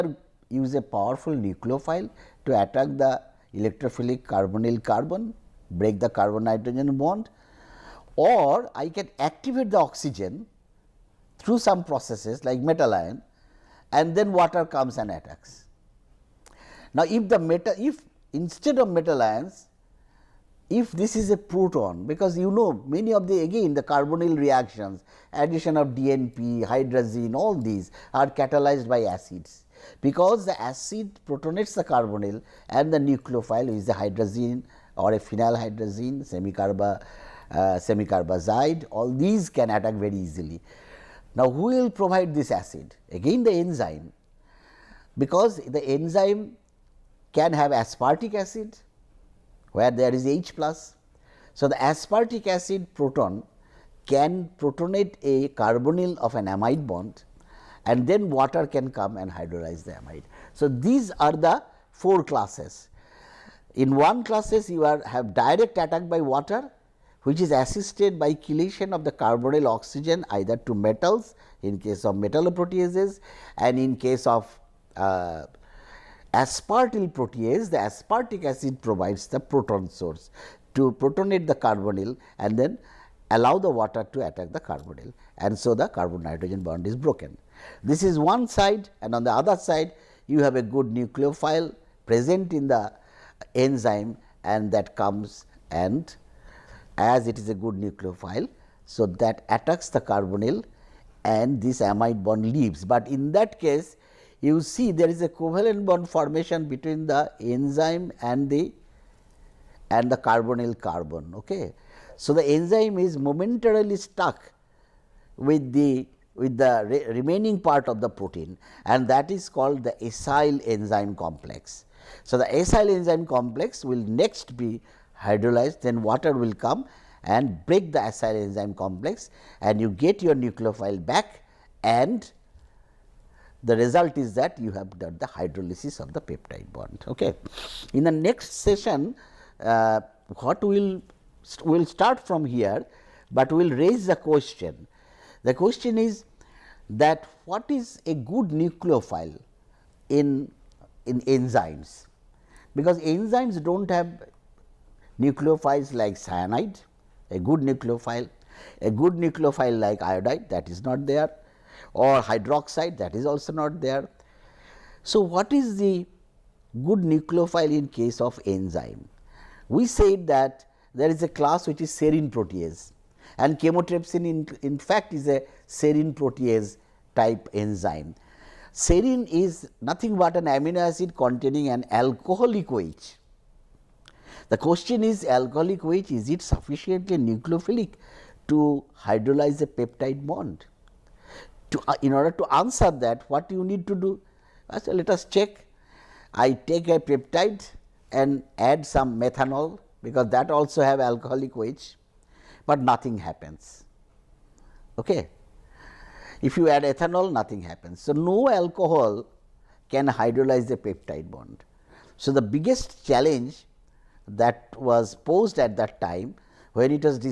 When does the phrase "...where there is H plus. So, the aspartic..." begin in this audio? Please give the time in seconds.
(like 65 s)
49 s.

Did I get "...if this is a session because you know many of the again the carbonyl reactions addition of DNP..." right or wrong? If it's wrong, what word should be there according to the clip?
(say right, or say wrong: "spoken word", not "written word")
wrong: "proton", not "session".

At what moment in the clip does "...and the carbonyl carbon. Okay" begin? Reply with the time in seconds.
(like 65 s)
109 s.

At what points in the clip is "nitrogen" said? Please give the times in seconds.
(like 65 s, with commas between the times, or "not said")
6 s, 86 s.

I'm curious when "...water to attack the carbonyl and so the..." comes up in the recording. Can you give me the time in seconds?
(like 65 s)
83 s.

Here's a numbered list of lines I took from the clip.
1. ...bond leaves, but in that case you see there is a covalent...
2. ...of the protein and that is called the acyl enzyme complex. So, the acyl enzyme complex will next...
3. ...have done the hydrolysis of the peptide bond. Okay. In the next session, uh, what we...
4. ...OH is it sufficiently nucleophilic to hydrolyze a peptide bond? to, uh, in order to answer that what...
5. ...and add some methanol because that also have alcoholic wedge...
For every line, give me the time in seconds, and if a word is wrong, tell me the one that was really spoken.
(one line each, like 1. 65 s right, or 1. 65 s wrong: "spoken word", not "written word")
1. 102 s right
2. 117 s right
3. 134 s right
4. 185 s right
5. 198 s right.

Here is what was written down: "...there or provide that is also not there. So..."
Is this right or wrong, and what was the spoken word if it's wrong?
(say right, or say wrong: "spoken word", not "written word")
wrong: "hydroxide", not "provide".